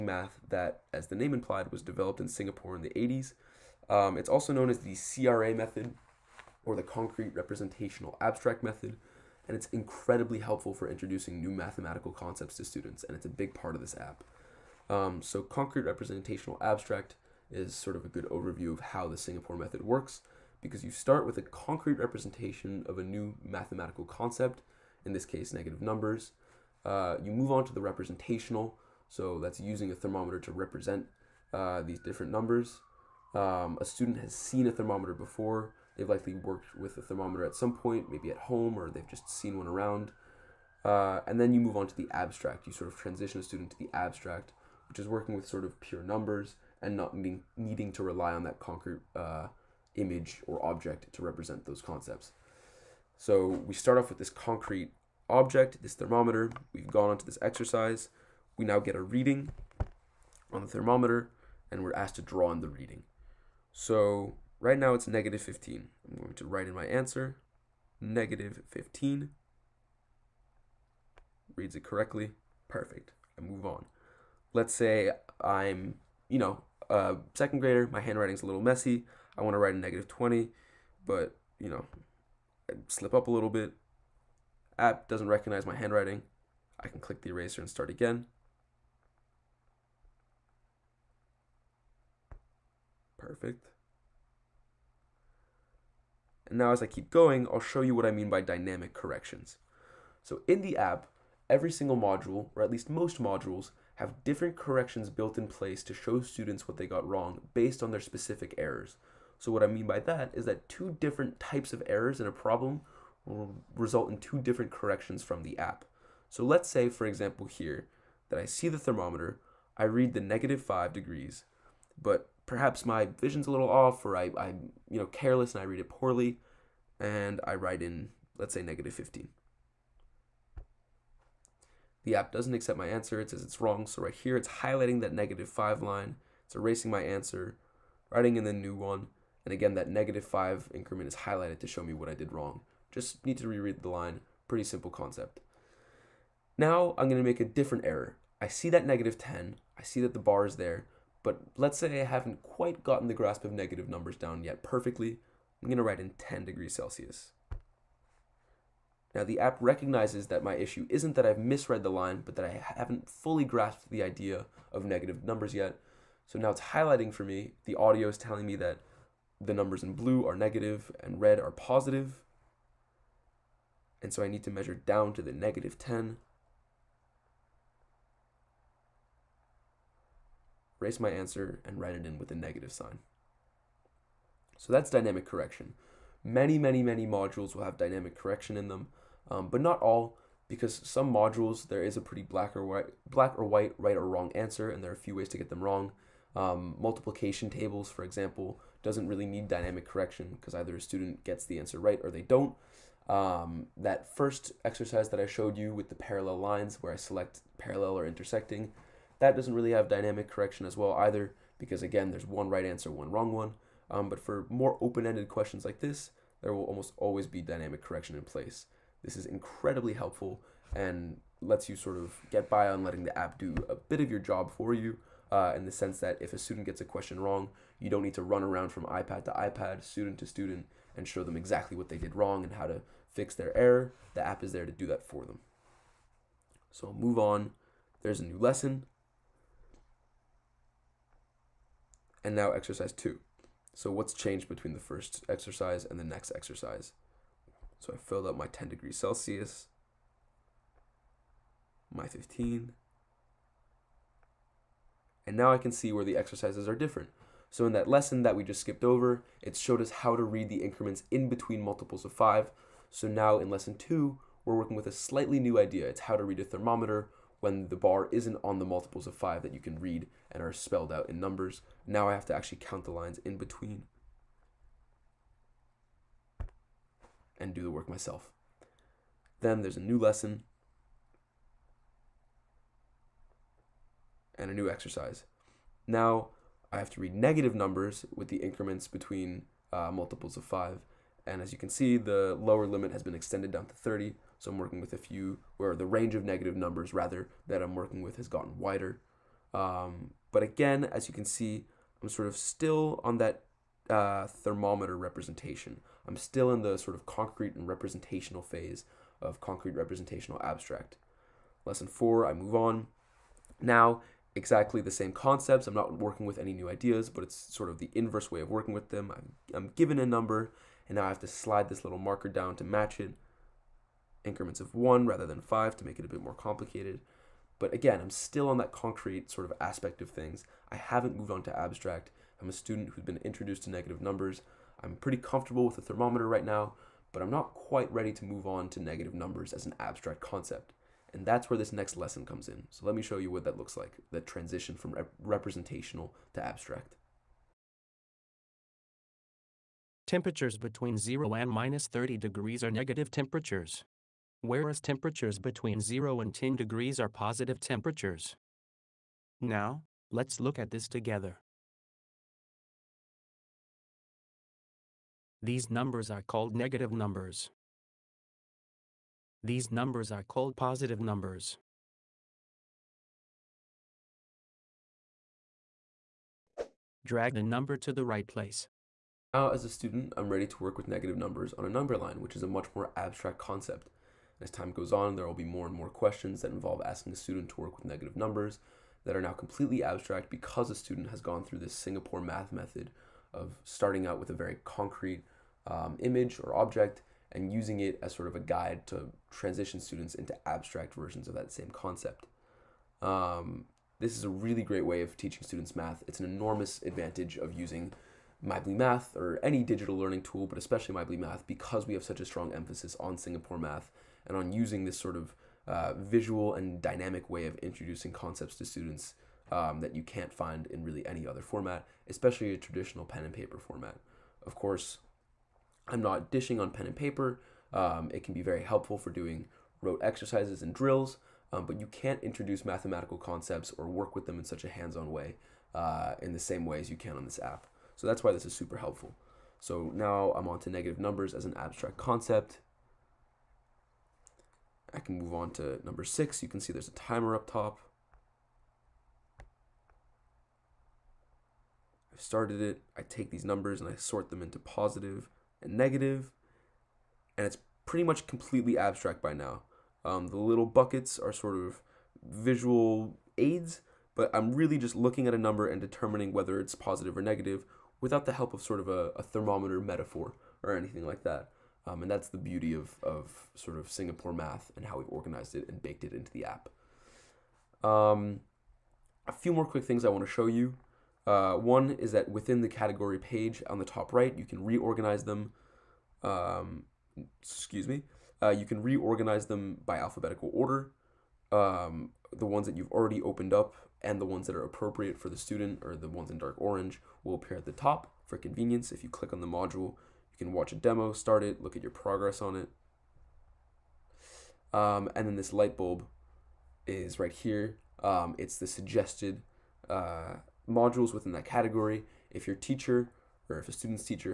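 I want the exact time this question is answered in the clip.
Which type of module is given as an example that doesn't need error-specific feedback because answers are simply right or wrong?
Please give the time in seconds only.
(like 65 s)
196 s.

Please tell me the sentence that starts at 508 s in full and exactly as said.
Um, it's the suggested uh, modules within that category.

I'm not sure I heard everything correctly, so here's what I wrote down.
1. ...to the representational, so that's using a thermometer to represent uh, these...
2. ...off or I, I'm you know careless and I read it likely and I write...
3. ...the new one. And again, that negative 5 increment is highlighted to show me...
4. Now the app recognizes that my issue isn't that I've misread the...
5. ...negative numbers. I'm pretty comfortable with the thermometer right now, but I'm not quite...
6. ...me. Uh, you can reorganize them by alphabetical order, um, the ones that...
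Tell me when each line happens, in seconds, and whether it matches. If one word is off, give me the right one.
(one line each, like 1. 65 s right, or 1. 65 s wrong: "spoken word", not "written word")
1. 27 s right
2. 123 s wrong: "poorly", not "likely"
3. 138 s right
4. 159 s right
5. 333 s right
6. 487 s right.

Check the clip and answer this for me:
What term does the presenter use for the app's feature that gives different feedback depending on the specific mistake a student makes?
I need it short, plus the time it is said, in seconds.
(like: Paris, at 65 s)
dynamic corrections, at 98 s.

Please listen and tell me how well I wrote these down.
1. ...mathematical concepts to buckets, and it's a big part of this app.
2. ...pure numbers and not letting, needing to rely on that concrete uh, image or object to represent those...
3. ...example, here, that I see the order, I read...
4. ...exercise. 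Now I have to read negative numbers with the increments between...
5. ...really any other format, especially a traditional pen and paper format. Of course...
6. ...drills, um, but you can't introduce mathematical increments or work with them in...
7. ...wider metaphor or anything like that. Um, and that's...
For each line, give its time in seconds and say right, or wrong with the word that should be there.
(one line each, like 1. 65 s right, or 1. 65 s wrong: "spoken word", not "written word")
1. 11 s wrong: "students", not "buckets"
2. 45 s wrong: "needing", not "letting"
3. 117 s wrong: "thermometer", not "order"
4. 284 s right
5. 420 s right
6. 430 s wrong: "concepts", not "increments"
7. 469 s wrong: "thermometer", not "wider".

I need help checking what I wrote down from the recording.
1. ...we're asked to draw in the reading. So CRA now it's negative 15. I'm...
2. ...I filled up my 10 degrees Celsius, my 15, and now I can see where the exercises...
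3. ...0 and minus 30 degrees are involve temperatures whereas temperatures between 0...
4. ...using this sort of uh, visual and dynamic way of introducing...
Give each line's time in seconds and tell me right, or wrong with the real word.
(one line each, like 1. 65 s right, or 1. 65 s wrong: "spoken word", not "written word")
1. 61 s wrong: "Right", not "CRA"
2. 247 s right
3. 350 s wrong: "negative", not "involve"
4. 414 s right.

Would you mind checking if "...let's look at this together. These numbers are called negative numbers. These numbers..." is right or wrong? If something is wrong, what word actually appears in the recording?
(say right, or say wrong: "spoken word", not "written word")
right.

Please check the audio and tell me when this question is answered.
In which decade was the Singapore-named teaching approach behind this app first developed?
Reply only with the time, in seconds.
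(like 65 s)
2 s.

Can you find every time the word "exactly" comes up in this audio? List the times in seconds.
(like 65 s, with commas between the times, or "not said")
231 s, 314 s.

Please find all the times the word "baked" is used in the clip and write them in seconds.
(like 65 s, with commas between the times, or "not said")
475 s.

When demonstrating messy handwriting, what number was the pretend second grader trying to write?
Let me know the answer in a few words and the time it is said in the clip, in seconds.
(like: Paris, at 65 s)
-20, at 79 s.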